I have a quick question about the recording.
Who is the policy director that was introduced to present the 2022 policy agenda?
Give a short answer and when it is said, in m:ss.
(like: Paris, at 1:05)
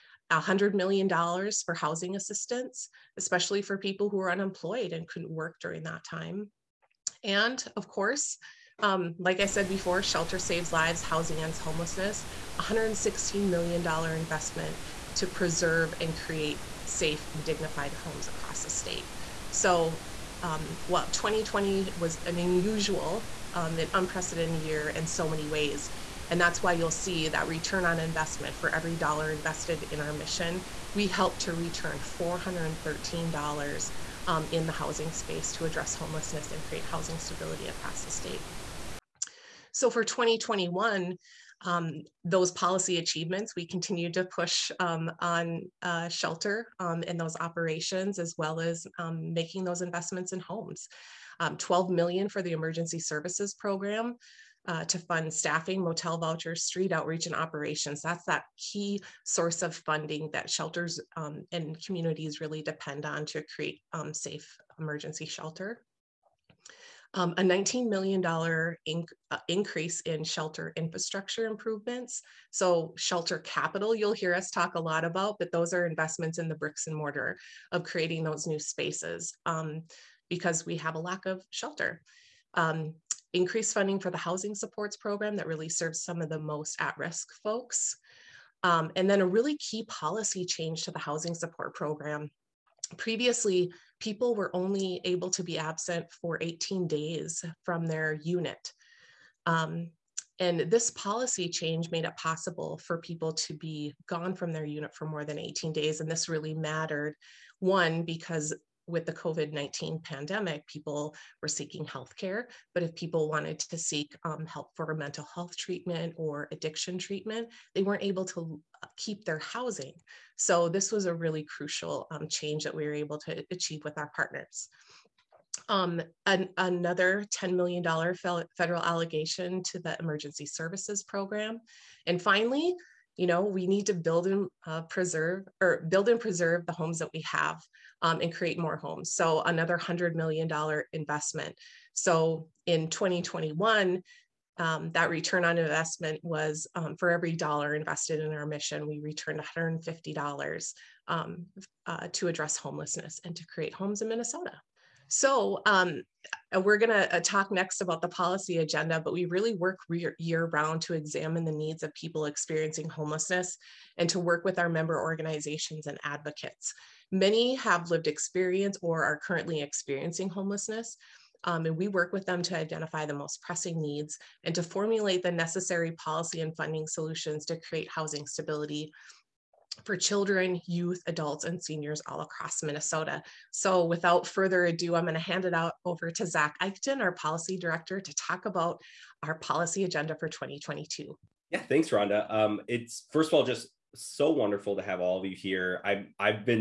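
Zach Eichten, at 3:06.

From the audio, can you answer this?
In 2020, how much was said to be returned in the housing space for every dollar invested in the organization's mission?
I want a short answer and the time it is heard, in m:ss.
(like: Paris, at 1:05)
$413, at 0:32.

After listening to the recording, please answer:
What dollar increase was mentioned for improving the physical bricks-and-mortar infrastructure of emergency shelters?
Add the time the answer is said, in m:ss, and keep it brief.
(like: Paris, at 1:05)
$19 million, at 1:07.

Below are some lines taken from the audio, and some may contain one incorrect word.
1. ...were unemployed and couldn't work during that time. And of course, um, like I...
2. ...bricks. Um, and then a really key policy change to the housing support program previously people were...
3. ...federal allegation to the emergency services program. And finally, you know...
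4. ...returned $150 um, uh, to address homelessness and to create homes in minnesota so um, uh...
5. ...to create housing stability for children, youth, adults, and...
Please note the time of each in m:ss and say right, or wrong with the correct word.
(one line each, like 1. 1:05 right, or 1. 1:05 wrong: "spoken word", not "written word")
1. 0:04 right
2. 1:27 wrong: "folks", not "bricks"
3. 2:08 right
4. 2:28 right
5. 2:57 right.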